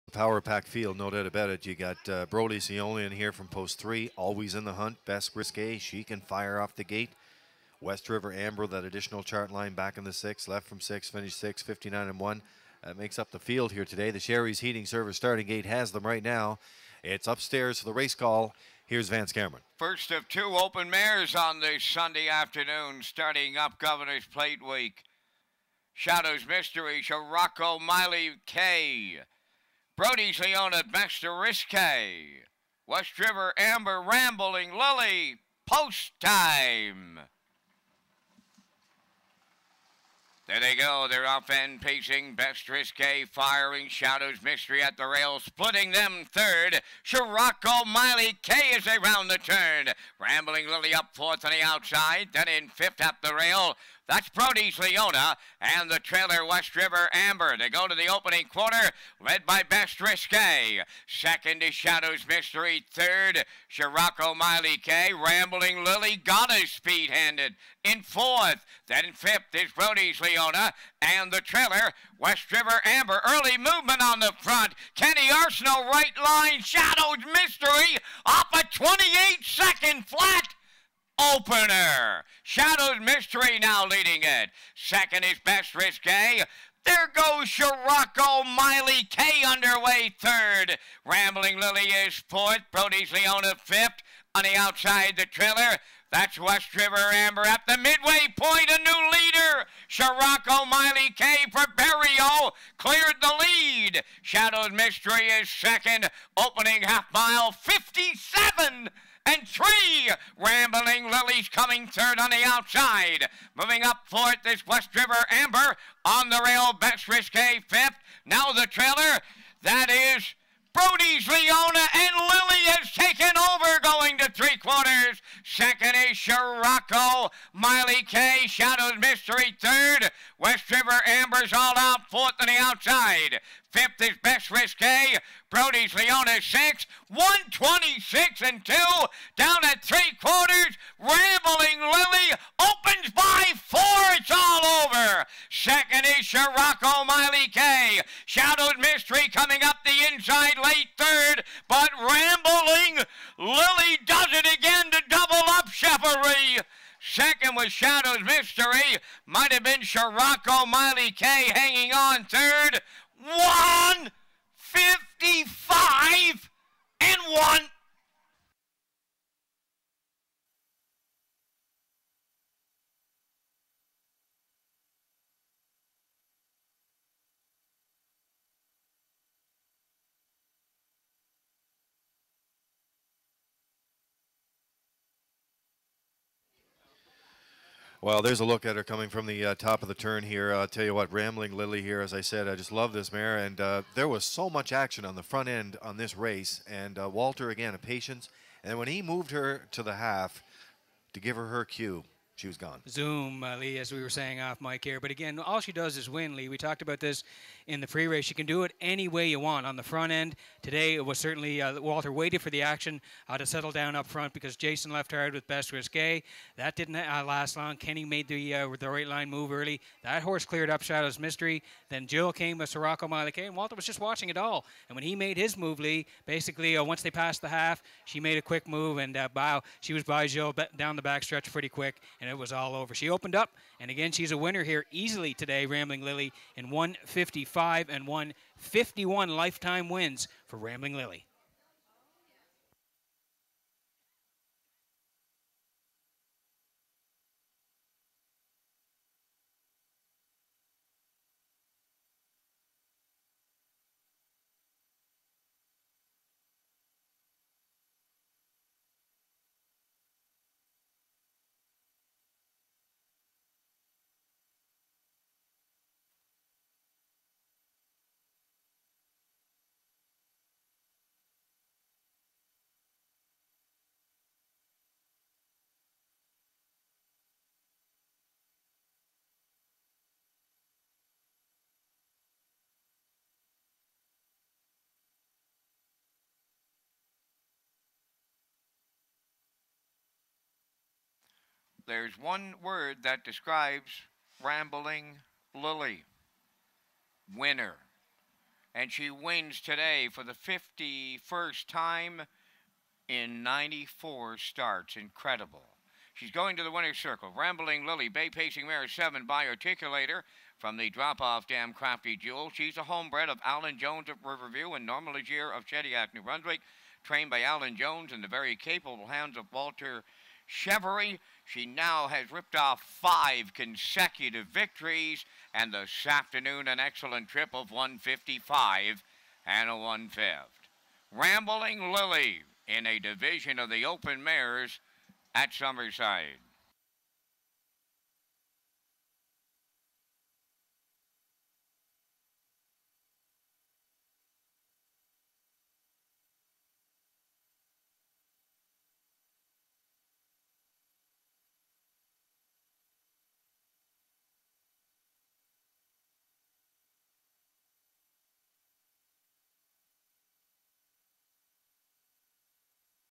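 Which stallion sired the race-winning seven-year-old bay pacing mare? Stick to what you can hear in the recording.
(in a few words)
Articulator.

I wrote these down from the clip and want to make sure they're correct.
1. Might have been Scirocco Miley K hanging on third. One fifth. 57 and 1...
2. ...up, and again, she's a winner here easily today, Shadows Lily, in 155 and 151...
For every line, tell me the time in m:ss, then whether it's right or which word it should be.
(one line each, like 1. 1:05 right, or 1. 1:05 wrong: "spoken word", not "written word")
1. 2:39 wrong: "55", not "57"
2. 3:53 wrong: "Rambling", not "Shadows".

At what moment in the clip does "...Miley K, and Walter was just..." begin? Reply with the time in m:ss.
3:43.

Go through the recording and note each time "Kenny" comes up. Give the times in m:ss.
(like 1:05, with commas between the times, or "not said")
1:14, 3:37.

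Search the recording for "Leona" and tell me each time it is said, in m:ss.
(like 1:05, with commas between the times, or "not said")
0:02, 0:30, 0:54, 1:10, 1:33, 2:01, 2:15.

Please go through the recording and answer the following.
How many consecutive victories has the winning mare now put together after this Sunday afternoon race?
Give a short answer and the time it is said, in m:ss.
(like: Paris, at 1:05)
5, at 5:22.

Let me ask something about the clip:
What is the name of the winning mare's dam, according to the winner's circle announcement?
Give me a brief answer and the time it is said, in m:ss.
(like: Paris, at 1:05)
Crafty Jewel, at 5:11.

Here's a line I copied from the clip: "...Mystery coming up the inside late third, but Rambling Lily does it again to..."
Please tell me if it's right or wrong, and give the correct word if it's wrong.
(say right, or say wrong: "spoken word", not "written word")
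right.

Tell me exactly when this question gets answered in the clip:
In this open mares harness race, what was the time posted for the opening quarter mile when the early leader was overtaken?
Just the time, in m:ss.
1:18.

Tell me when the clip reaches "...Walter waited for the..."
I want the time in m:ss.
3:31.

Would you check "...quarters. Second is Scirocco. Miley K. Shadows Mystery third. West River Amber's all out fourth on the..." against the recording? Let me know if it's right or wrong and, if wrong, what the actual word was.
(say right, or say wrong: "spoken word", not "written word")
right.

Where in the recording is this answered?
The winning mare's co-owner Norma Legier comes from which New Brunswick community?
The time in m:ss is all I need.
5:15.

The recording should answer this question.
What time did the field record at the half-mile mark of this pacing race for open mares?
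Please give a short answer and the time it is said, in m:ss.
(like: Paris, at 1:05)
57 and 3, at 1:47.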